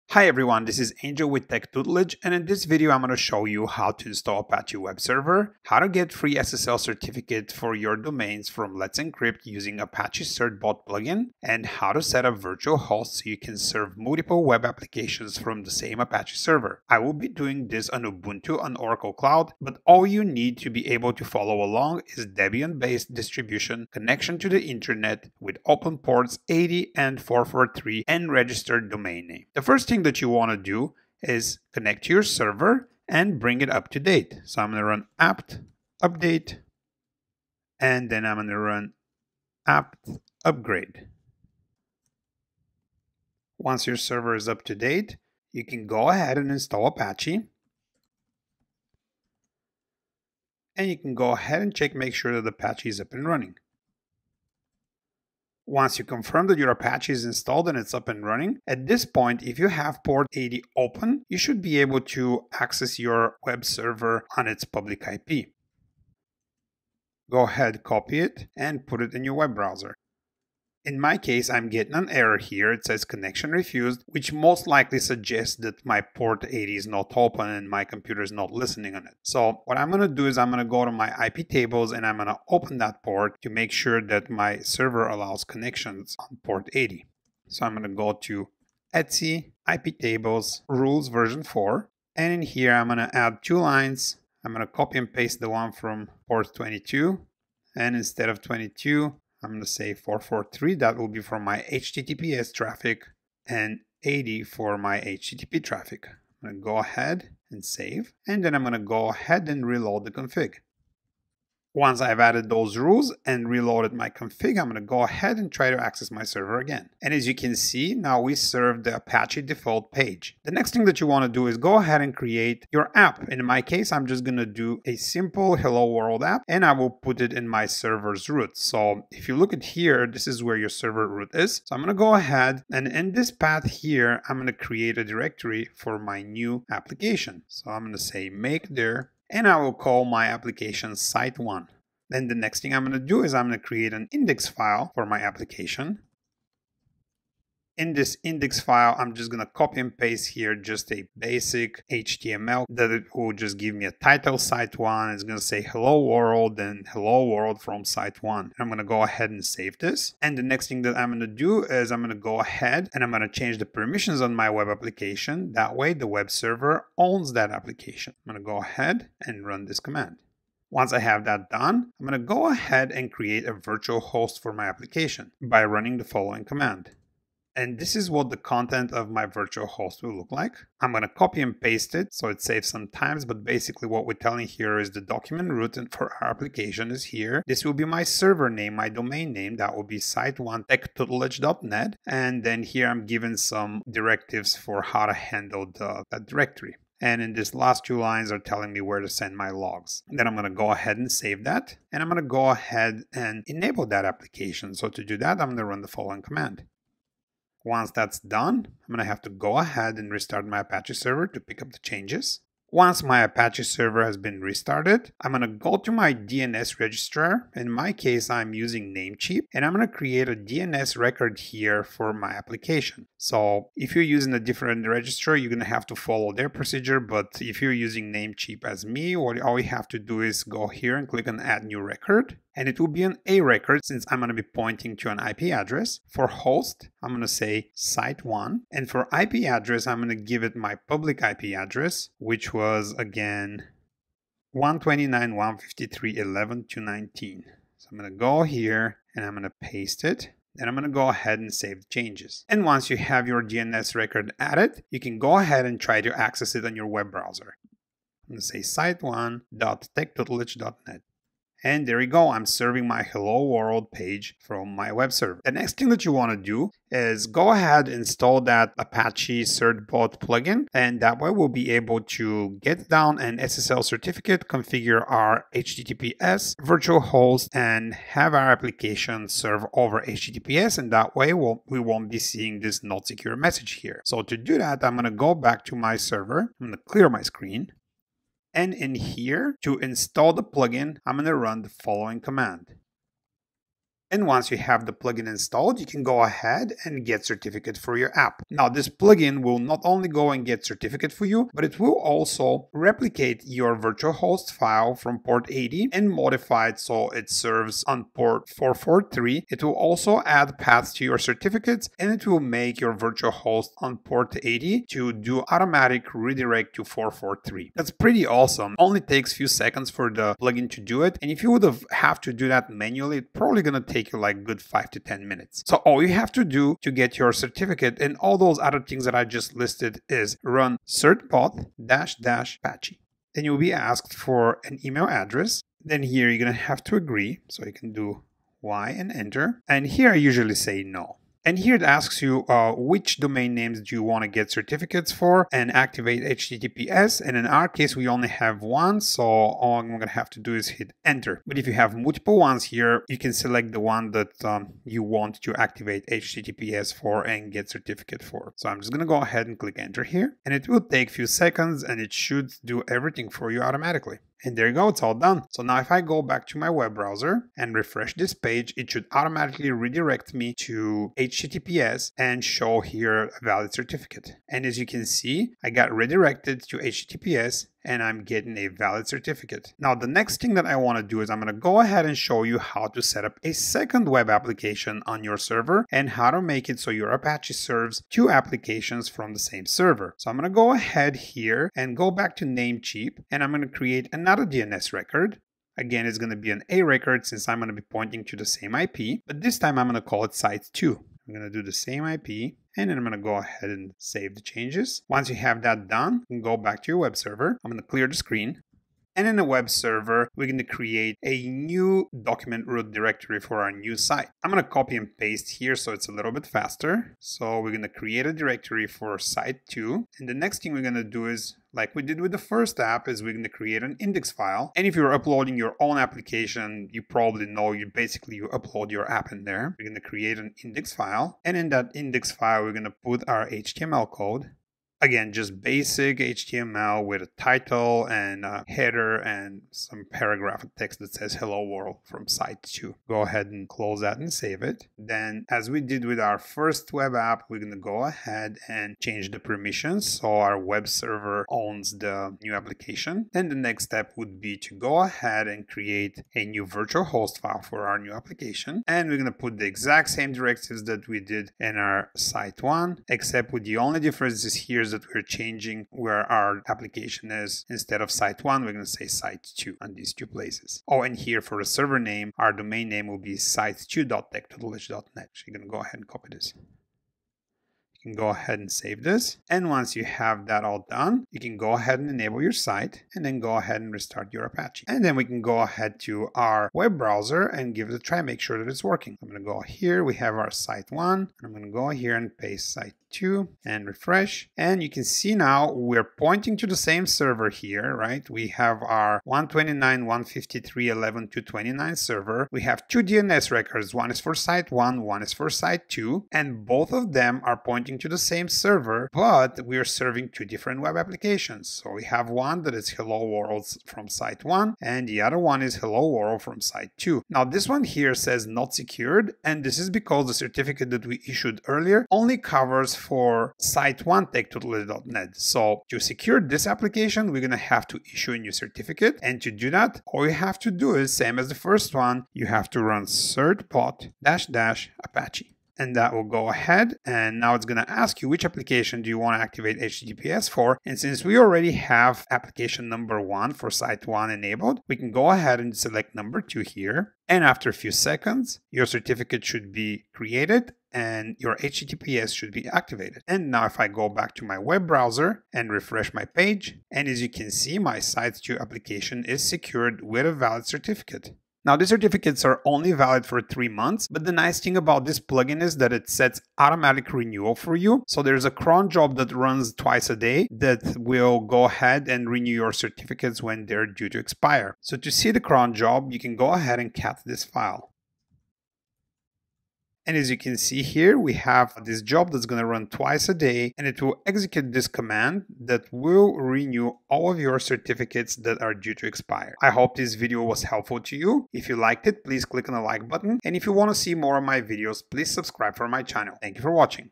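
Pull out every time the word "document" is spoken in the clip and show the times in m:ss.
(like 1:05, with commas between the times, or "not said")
3:05, 6:52.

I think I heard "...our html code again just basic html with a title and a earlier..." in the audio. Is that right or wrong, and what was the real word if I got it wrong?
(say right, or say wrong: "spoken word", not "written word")
wrong: "header", not "earlier".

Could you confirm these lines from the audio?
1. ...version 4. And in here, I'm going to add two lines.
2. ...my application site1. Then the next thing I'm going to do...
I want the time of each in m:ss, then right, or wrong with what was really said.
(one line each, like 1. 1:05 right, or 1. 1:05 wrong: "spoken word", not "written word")
1. 1:31 right
2. 2:20 right.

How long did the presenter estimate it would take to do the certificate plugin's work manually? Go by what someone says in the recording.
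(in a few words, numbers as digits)
5 to 10 minutes.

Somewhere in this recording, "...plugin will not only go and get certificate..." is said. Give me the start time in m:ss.
4:58.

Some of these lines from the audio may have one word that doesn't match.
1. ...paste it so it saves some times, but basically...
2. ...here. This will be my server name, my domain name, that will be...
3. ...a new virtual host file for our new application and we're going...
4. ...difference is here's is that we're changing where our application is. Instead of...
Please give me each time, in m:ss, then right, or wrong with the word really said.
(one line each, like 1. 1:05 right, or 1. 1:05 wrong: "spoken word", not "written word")
1. 3:01 right
2. 3:07 right
3. 7:36 right
4. 7:43 right.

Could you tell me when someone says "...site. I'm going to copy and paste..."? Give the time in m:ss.
6:53.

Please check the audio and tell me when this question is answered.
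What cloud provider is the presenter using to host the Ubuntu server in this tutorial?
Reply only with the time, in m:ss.
0:18.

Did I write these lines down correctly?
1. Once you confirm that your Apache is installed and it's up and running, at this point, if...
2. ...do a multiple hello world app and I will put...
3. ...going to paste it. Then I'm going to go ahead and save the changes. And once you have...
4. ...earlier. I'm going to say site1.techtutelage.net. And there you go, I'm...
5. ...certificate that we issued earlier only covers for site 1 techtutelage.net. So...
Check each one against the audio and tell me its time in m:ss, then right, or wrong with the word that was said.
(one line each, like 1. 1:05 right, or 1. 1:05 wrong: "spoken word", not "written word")
1. 0:55 right
2. 2:04 wrong: "simple", not "multiple"
3. 4:09 right
4. 4:17 wrong: "browser", not "earlier"
5. 8:40 right.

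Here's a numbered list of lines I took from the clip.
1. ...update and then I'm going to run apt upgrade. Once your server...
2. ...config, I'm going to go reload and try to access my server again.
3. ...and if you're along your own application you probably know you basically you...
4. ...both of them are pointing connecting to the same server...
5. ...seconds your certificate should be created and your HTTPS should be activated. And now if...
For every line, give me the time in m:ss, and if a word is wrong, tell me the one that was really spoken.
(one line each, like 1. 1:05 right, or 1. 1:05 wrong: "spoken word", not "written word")
1. 0:36 right
2. 1:54 wrong: "ahead", not "reload"
3. 7:04 wrong: "uploading", not "along"
4. 8:26 right
5. 9:07 right.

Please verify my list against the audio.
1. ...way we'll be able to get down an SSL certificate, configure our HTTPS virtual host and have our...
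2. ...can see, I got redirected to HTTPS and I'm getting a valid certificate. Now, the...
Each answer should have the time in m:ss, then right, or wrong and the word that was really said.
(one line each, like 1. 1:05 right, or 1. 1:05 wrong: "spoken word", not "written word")
1. 4:31 right
2. 6:14 right.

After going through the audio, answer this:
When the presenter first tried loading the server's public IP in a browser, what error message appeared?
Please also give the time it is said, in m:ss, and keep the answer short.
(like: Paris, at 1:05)
Connection refused, at 1:13.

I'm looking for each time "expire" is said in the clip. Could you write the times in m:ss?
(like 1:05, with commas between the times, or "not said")
9:34, 9:49.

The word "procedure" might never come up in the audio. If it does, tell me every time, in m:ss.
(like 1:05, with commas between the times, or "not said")
3:46.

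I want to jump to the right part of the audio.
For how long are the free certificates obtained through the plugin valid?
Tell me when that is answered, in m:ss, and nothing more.
9:23.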